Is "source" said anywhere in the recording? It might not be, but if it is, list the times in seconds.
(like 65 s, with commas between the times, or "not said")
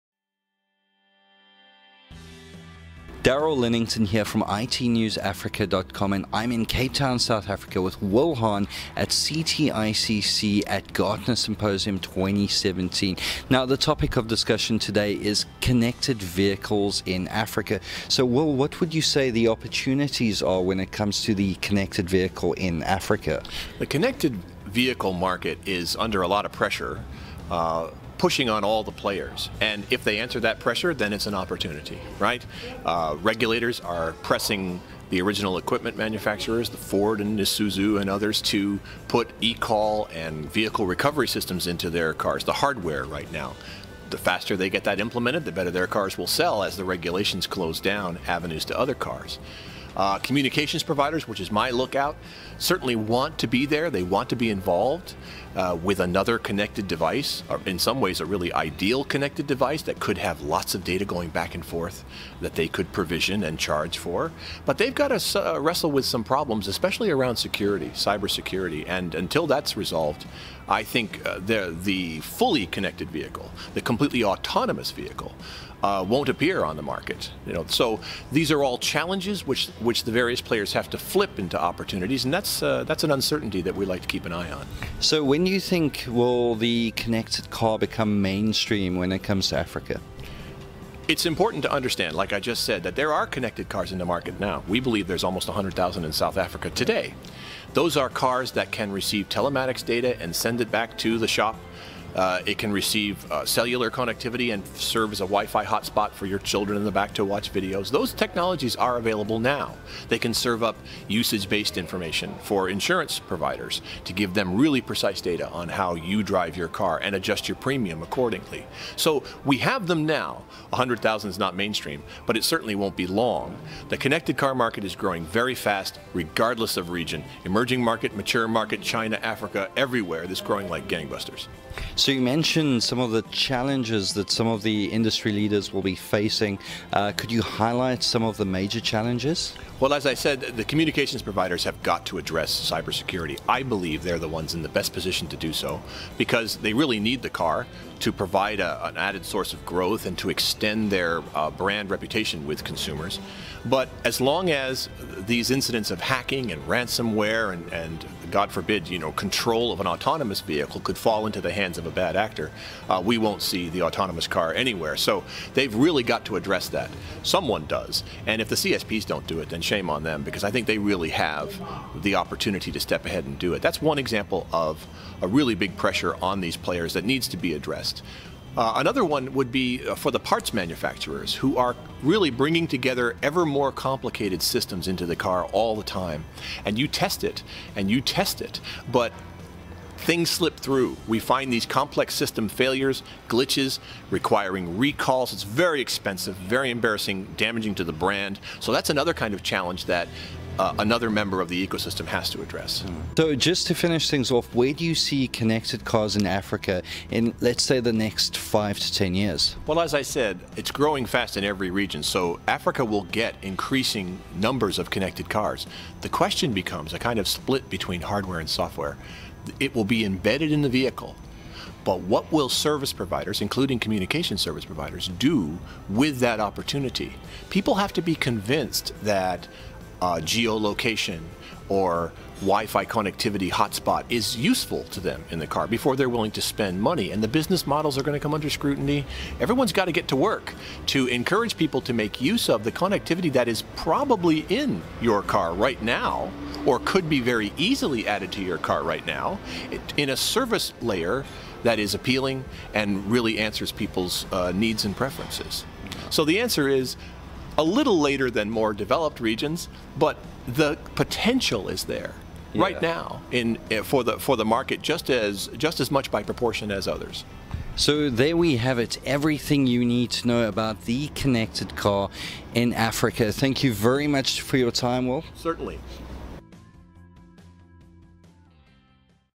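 149 s.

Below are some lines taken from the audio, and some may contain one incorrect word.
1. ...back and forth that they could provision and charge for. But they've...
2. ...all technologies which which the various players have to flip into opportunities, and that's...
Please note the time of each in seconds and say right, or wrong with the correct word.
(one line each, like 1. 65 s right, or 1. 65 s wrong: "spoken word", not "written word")
1. 61 s right
2. 78 s wrong: "challenges", not "technologies".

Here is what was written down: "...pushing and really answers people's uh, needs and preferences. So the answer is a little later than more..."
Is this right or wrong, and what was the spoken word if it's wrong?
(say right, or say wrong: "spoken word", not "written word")
wrong: "appealing", not "pushing".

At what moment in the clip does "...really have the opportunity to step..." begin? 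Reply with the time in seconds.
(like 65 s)
170 s.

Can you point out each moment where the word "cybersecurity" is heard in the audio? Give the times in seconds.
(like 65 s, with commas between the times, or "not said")
67 s, 142 s.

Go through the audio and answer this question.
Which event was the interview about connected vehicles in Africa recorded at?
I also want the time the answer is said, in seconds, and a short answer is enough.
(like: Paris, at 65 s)
Gartner Symposium 2017, at 10 s.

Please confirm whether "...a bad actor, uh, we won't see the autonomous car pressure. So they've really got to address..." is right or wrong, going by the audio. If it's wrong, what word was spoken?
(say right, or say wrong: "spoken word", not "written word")
wrong: "anywhere", not "pressure".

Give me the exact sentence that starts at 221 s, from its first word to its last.
But what will service providers, including communication service providers, do with that opportunity?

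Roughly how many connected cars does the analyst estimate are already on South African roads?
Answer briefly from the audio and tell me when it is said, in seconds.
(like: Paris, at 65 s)
100,000, at 95 s.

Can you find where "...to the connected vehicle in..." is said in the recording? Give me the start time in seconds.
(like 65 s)
21 s.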